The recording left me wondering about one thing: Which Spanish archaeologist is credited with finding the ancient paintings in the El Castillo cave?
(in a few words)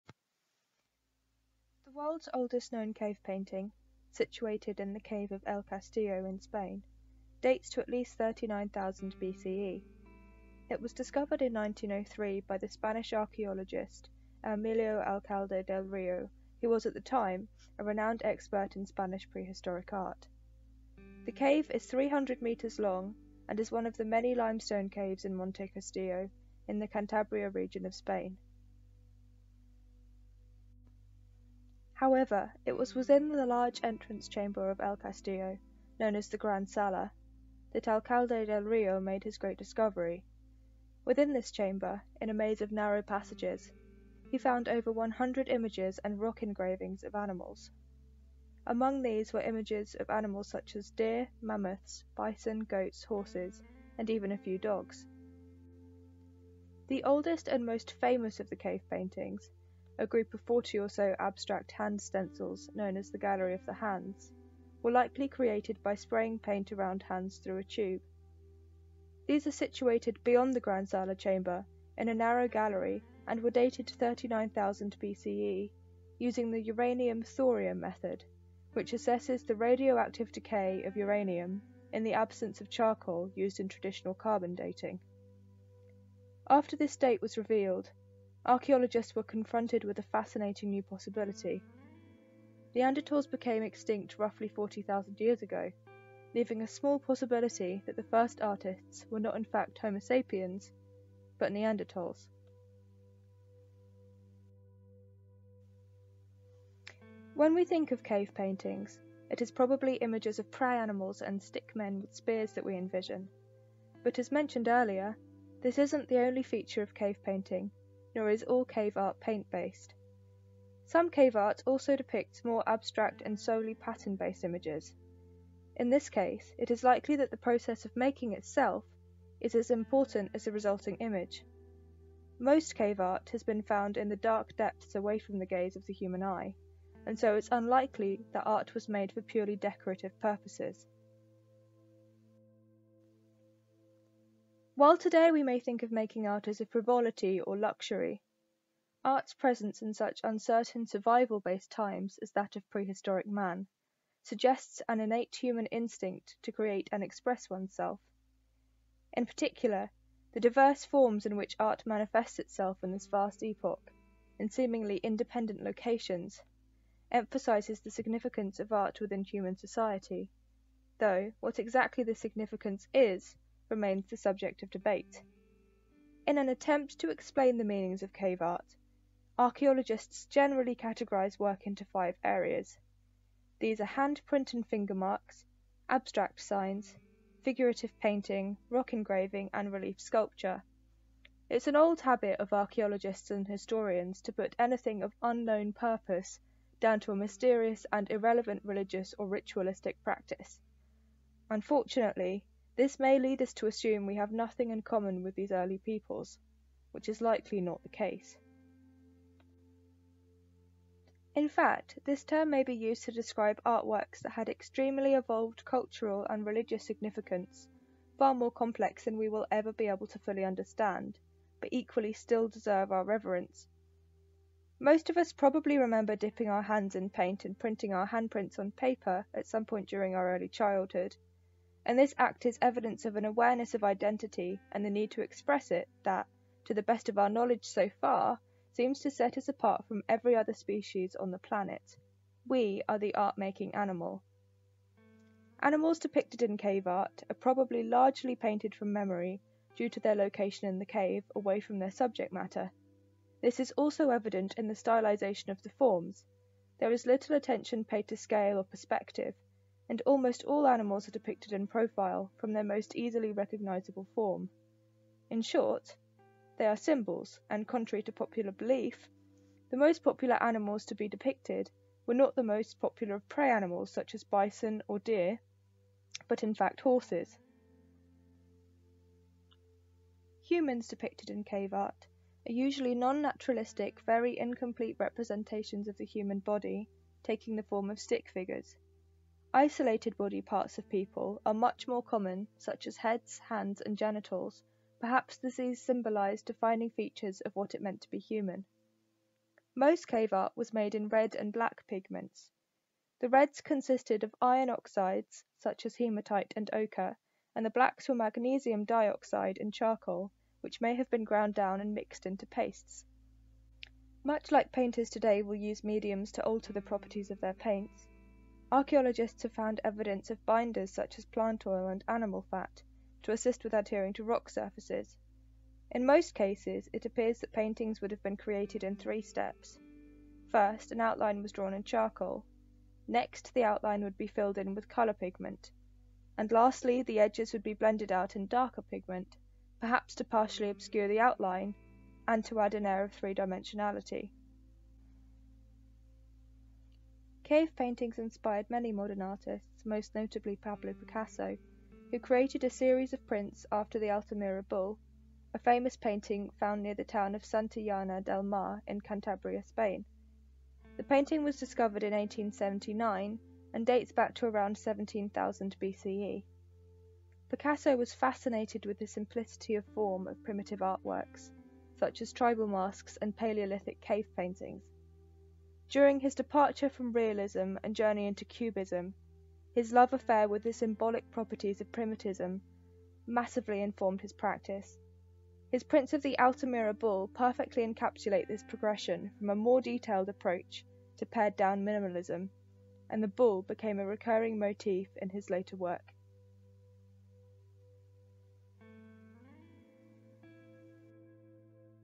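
Emilio Alcalde del Rio.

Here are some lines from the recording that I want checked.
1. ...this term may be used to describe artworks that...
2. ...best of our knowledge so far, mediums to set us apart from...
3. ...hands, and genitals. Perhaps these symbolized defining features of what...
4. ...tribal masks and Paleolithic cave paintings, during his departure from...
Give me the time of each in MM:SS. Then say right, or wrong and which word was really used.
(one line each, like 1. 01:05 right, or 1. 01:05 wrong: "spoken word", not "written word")
1. 03:32 right
2. 03:56 wrong: "seems", not "mediums"
3. 04:53 right
4. 06:12 right.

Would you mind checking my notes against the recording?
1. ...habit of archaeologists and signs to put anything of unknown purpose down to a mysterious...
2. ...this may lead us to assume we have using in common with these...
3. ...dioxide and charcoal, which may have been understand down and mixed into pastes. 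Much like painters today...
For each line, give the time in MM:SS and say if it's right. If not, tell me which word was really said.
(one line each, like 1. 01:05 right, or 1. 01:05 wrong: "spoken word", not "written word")
1. 03:12 wrong: "historians", not "signs"
2. 03:22 wrong: "nothing", not "using"
3. 05:08 wrong: "ground", not "understand".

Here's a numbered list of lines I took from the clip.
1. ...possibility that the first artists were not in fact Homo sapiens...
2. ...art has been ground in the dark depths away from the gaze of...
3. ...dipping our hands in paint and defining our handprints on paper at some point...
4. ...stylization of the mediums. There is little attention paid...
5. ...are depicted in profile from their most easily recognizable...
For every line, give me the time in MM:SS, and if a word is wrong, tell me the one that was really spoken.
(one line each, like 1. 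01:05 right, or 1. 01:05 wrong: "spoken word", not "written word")
1. 01:36 right
2. 02:12 wrong: "found", not "ground"
3. 03:46 wrong: "printing", not "defining"
4. 04:14 wrong: "forms", not "mediums"
5. 04:21 right.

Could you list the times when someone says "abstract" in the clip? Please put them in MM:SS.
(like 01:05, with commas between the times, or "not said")
01:01, 02:02, 03:05.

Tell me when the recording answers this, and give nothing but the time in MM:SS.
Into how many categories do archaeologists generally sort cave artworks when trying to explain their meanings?
03:01.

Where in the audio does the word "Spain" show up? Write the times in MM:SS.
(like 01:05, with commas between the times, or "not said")
00:06, 00:27, 05:59.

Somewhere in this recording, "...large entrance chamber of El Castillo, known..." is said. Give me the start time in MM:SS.
00:33.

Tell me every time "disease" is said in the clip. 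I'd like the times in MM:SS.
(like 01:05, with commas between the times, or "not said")
not said.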